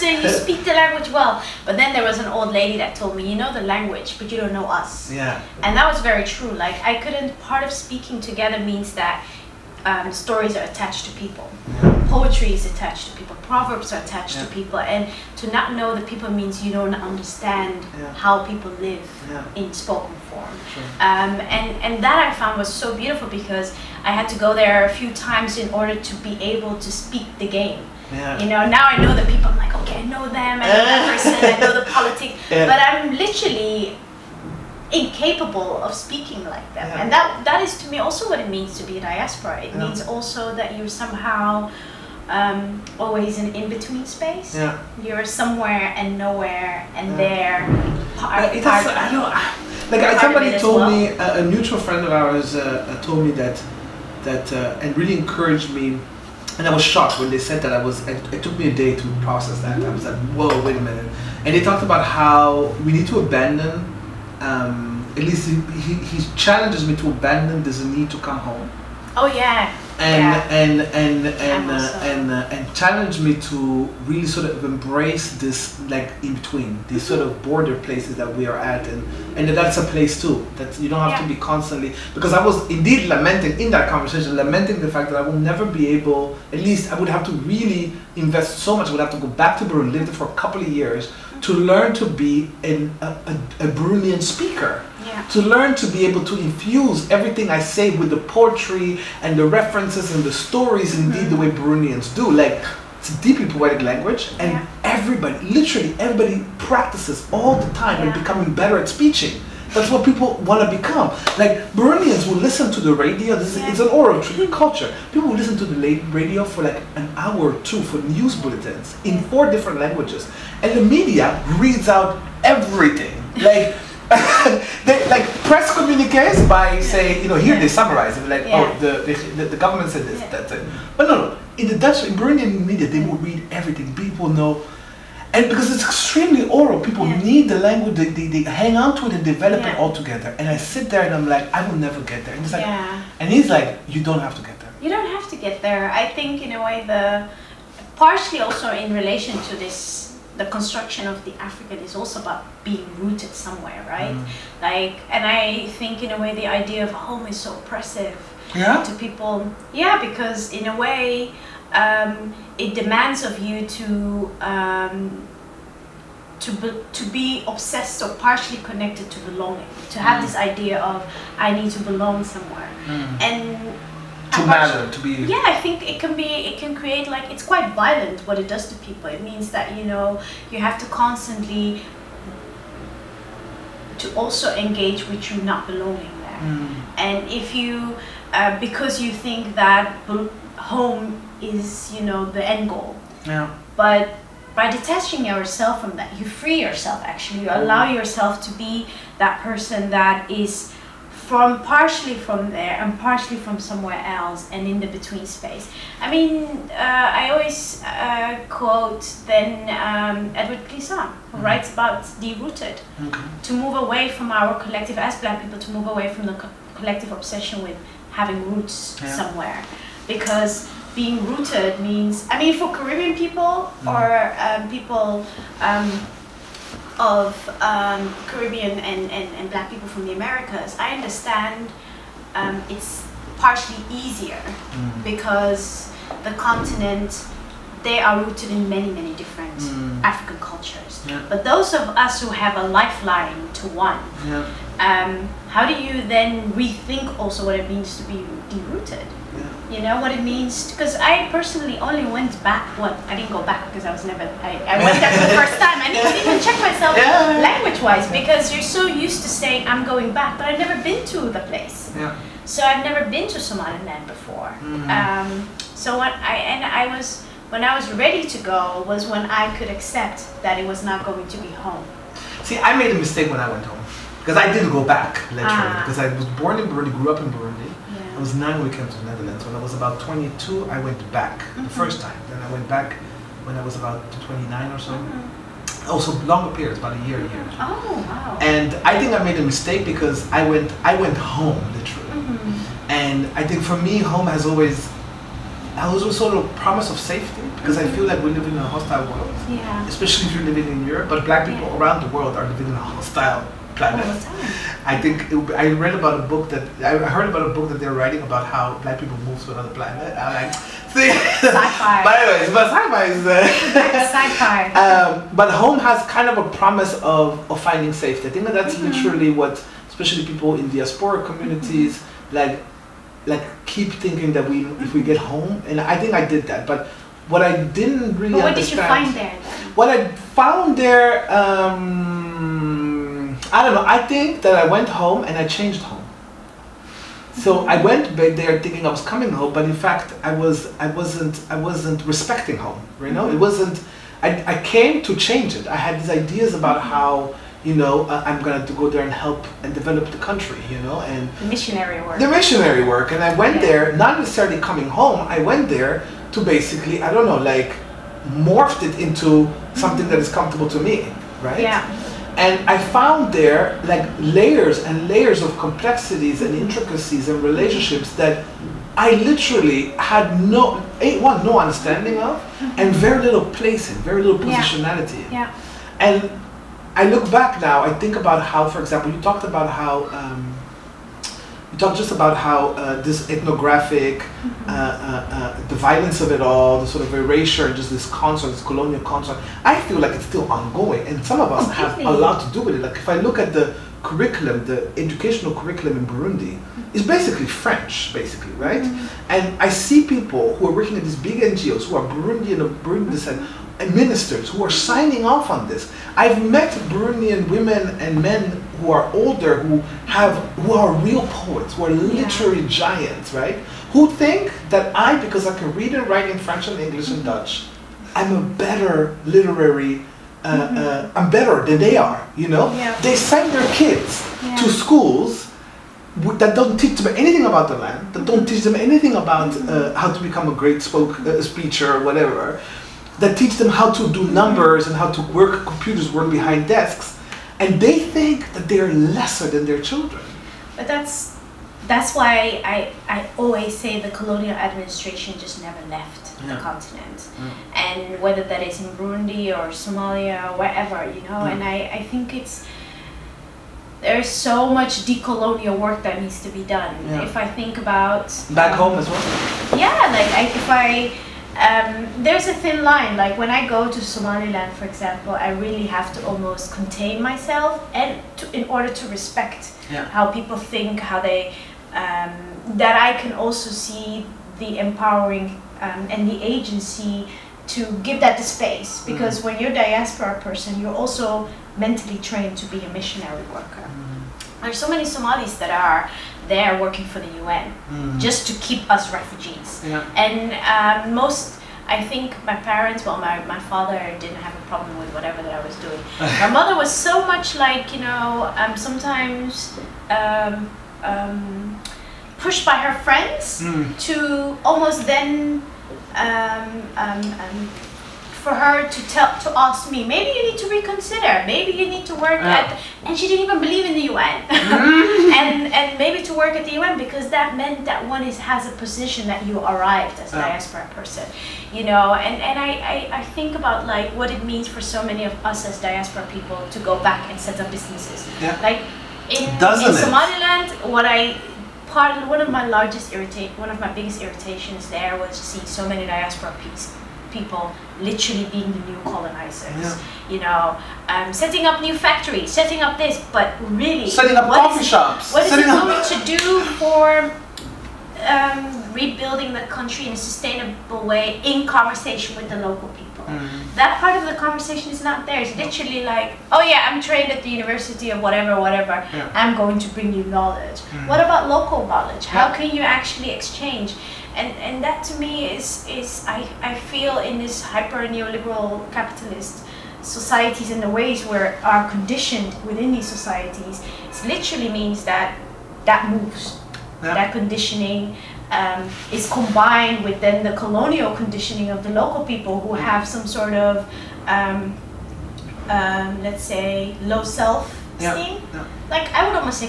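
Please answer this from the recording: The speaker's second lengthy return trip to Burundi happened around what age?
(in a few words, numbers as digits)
29.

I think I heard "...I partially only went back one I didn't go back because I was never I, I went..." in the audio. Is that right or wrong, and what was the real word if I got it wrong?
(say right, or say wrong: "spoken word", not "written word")
wrong: "personally", not "partially".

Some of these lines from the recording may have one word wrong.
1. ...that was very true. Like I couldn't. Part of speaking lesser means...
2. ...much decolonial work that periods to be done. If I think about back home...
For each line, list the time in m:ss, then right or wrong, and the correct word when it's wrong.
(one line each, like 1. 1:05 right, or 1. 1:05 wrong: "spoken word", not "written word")
1. 0:05 wrong: "together", not "lesser"
2. 7:34 wrong: "needs", not "periods".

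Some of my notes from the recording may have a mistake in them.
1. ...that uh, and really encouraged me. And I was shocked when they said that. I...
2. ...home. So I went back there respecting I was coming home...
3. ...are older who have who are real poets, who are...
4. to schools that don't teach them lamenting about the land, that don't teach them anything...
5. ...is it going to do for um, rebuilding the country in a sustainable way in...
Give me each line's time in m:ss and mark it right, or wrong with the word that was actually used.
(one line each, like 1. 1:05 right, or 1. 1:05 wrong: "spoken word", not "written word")
1. 0:54 right
2. 5:35 wrong: "thinking", not "respecting"
3. 6:48 right
4. 7:04 wrong: "anything", not "lamenting"
5. 9:05 right.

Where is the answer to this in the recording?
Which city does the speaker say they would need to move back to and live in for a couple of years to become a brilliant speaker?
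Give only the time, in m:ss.
1:29.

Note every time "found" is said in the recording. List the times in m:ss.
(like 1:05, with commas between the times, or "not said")
0:22, 5:30, 6:02.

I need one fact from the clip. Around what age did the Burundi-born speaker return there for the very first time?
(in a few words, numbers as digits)
22.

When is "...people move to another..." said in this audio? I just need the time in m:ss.
5:08.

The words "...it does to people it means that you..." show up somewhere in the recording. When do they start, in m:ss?
2:58.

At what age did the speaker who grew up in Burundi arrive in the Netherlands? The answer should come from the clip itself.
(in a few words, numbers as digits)
9.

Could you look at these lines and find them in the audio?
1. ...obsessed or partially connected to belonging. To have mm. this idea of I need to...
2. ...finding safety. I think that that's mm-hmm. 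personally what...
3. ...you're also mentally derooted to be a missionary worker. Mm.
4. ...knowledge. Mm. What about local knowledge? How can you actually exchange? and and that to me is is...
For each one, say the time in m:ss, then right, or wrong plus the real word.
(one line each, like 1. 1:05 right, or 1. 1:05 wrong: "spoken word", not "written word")
1. 2:47 right
2. 5:17 wrong: "literally", not "personally"
3. 8:00 wrong: "trained", not "derooted"
4. 9:20 right.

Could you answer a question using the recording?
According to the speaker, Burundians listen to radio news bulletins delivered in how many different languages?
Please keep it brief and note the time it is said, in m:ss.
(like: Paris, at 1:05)
4, at 1:59.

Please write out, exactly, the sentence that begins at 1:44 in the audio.
everybody, literally everybody, practices all the time yeah.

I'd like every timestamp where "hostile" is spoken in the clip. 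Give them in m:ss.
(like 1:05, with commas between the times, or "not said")
4:58, 5:02.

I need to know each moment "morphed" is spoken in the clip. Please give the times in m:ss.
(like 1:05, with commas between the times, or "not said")
5:58.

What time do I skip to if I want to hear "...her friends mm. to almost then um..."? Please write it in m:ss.
8:22.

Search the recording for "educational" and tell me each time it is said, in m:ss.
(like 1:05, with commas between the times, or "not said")
6:34.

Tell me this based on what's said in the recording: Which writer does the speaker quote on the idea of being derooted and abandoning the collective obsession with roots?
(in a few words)
Edouard Glissant.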